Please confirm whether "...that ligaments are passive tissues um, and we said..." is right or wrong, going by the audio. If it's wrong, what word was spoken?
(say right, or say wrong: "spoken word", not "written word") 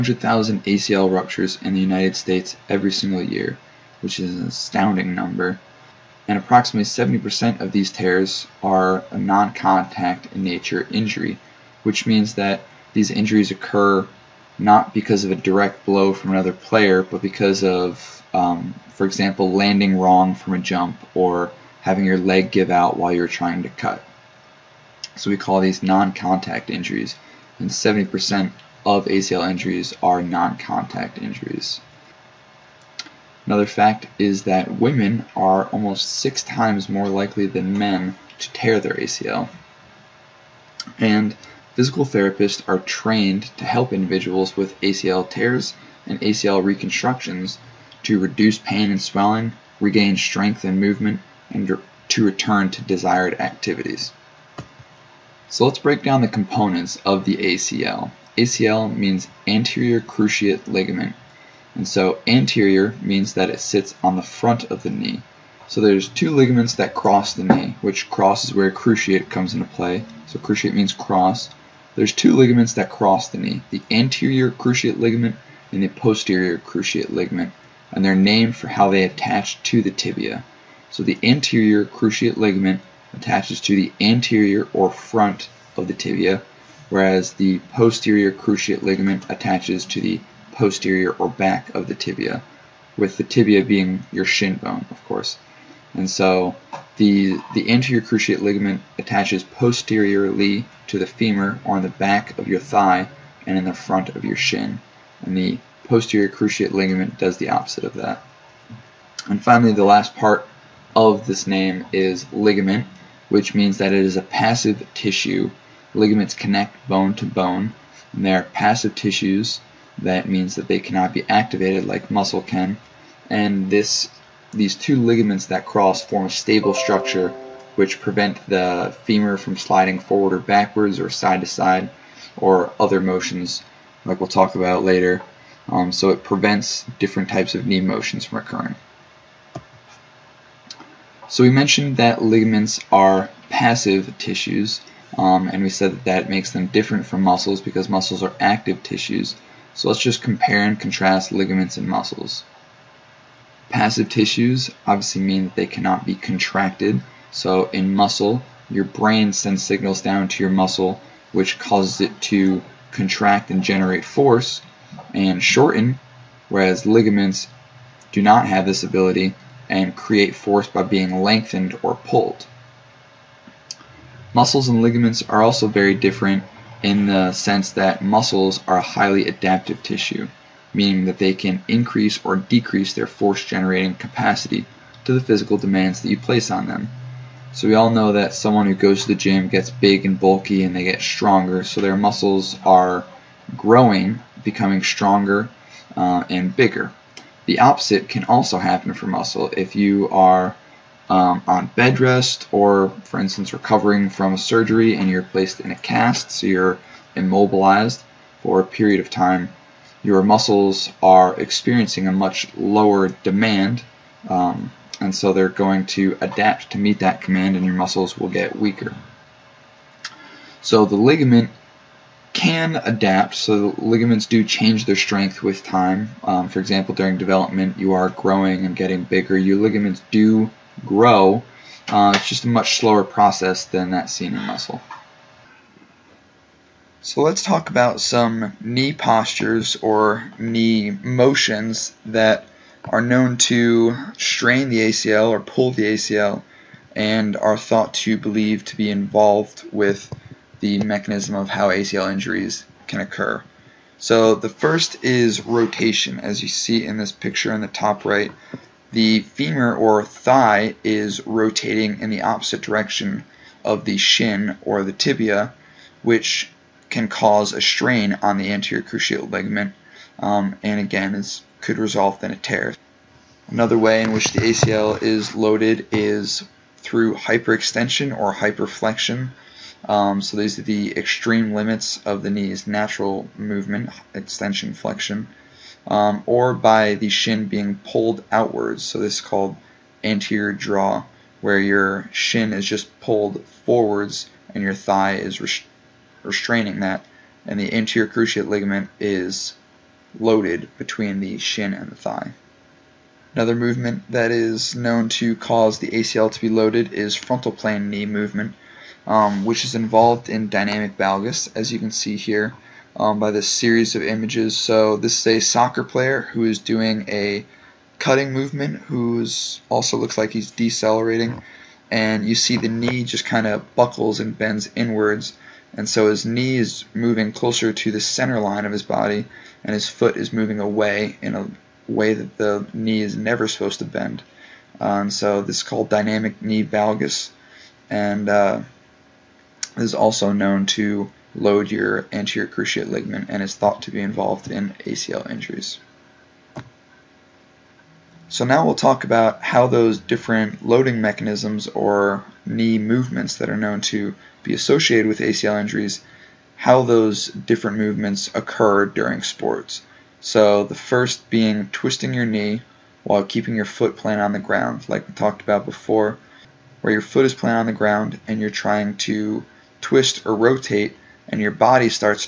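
right.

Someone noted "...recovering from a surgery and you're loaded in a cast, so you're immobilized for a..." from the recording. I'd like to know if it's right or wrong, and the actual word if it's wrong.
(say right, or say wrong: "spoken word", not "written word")
wrong: "placed", not "loaded".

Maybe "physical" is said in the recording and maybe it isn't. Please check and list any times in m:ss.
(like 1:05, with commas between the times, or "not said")
0:41, 3:05.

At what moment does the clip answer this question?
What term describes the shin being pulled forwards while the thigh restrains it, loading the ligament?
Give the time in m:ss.
4:50.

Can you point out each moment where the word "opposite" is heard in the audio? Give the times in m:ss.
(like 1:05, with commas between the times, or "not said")
1:47, 3:17, 4:22.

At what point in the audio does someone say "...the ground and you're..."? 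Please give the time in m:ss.
6:07.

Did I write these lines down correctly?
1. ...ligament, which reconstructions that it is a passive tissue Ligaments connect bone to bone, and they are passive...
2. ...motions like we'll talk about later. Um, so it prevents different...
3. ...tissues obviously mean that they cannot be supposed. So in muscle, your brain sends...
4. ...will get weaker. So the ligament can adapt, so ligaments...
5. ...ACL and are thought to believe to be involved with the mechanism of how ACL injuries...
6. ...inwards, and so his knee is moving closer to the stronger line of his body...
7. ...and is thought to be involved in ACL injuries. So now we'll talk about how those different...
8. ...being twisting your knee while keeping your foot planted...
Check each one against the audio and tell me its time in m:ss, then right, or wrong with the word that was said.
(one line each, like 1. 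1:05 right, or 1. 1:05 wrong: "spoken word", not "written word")
1. 1:52 wrong: "means", not "reconstructions"
2. 2:12 right
3. 2:34 wrong: "contracted", not "supposed"
4. 3:38 right
5. 4:05 right
6. 5:24 wrong: "center", not "stronger"
7. 5:43 right
8. 6:01 right.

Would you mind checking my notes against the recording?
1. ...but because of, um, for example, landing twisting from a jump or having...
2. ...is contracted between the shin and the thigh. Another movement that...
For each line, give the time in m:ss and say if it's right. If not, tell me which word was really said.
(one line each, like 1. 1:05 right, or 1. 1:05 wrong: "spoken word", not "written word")
1. 0:17 wrong: "wrong", not "twisting"
2. 4:58 wrong: "loaded", not "contracted".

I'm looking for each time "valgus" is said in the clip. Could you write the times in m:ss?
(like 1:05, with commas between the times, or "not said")
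5:10, 5:36.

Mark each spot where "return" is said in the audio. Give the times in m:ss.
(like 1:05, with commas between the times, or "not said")
0:52.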